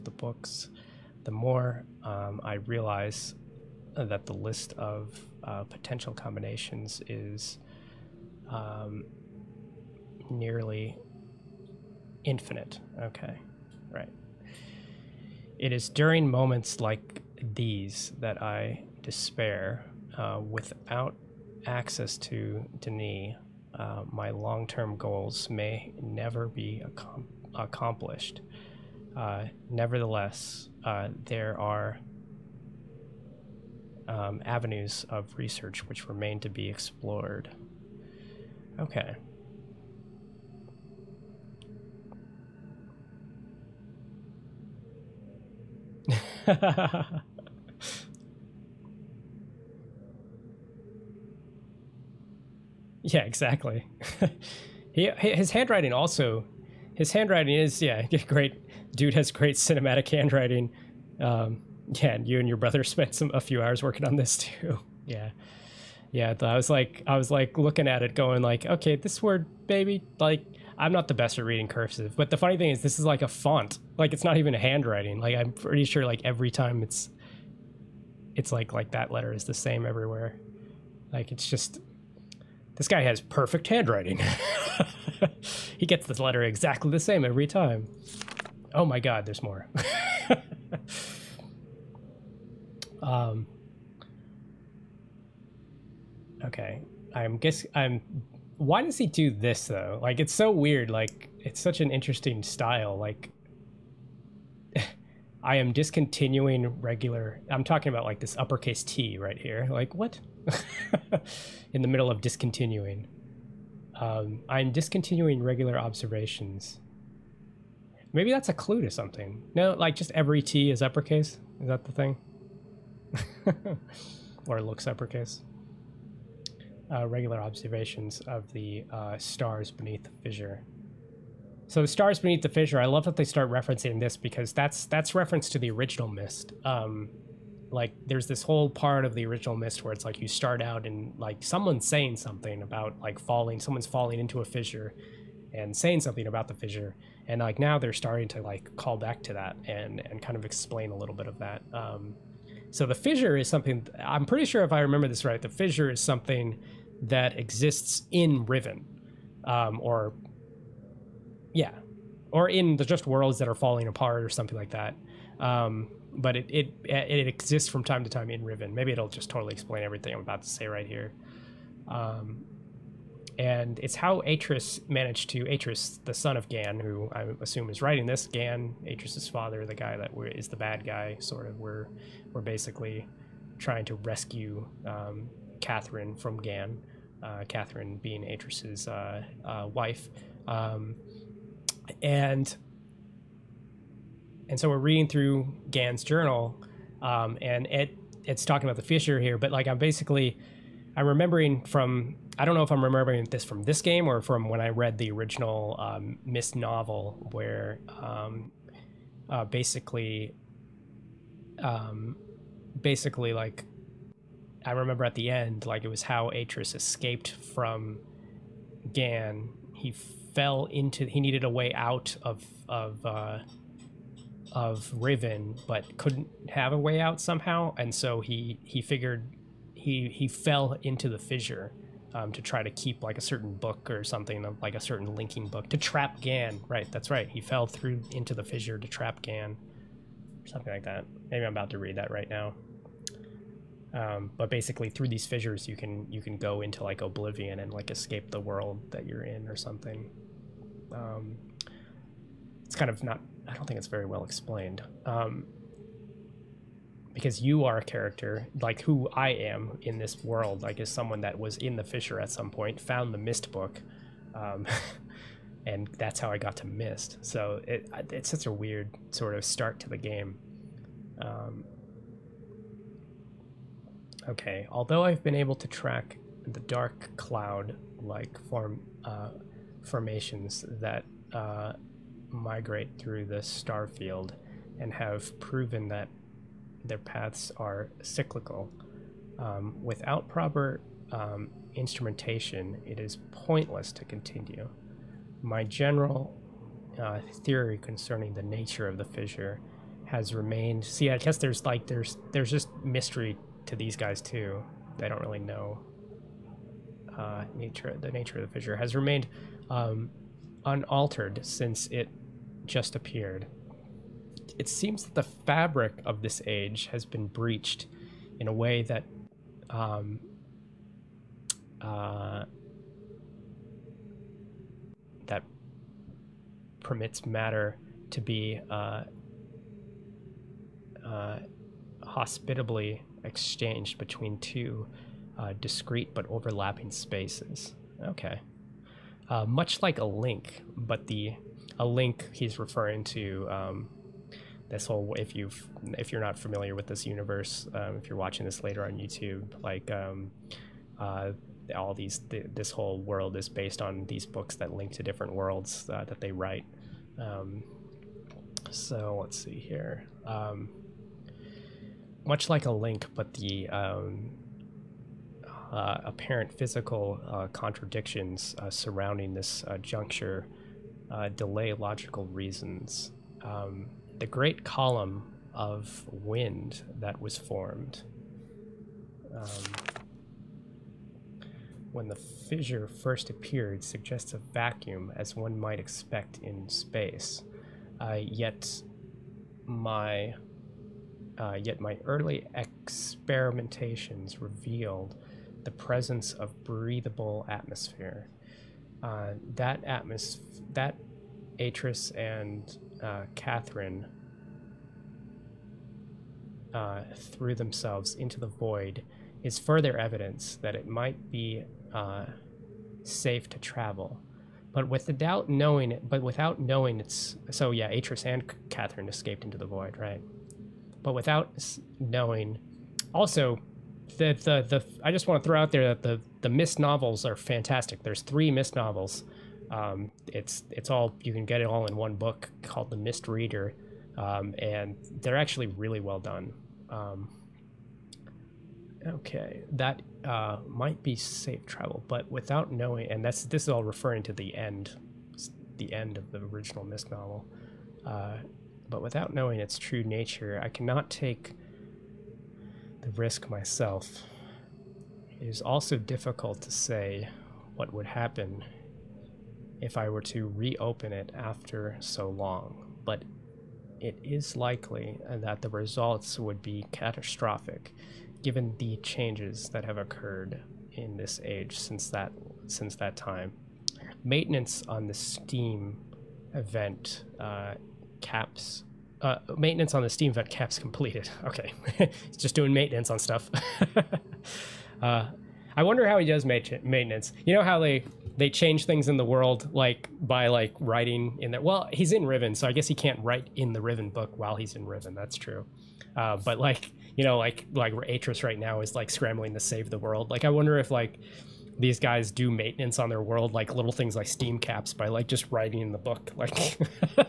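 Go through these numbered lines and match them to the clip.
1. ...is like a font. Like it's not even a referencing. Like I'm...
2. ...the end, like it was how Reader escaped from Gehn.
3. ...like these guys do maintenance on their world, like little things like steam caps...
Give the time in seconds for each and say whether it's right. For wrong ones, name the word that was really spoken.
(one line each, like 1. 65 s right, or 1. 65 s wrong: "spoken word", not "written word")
1. 72 s wrong: "handwriting", not "referencing"
2. 215 s wrong: "Atrus", not "Reader"
3. 500 s right.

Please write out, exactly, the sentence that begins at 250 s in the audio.
Um, it's kind of not I don't think it's very well explained.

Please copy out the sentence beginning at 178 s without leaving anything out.
Gehn, Atrus's father, the guy that is the bad guy, sort of.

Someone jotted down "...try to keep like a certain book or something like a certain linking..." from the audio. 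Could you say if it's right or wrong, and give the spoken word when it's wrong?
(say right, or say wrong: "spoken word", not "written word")
right.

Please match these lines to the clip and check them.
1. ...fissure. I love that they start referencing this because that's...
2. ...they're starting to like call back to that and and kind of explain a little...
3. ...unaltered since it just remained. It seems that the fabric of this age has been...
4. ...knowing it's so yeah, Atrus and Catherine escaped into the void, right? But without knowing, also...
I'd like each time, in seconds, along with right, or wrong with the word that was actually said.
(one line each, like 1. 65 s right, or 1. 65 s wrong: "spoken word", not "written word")
1. 132 s right
2. 147 s right
3. 310 s wrong: "appeared", not "remained"
4. 416 s right.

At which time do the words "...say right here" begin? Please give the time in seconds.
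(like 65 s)
170 s.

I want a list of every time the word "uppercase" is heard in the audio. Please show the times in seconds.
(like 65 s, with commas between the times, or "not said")
108 s, 120 s, 124 s.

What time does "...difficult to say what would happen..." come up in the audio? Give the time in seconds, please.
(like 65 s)
455 s.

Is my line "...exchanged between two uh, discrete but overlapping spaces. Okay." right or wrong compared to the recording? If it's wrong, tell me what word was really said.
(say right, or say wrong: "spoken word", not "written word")
right.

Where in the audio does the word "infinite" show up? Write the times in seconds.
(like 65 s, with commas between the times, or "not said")
12 s.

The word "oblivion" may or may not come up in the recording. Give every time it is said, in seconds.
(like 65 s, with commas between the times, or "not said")
247 s.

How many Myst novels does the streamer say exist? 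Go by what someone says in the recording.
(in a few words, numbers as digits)
3.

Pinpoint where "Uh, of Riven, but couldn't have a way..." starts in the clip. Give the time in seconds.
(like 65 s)
223 s.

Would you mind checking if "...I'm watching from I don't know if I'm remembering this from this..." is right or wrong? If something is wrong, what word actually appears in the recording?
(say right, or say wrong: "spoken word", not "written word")
wrong: "remembering", not "watching".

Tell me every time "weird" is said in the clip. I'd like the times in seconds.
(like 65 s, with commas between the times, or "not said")
100 s, 268 s.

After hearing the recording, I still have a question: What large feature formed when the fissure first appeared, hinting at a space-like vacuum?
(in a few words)
Great column of wind.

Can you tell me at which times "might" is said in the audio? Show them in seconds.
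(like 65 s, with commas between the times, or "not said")
385 s, 410 s, 440 s.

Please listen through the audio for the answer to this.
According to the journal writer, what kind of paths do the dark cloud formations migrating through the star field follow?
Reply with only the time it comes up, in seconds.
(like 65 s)
288 s.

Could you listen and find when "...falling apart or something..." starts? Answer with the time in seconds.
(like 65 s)
163 s.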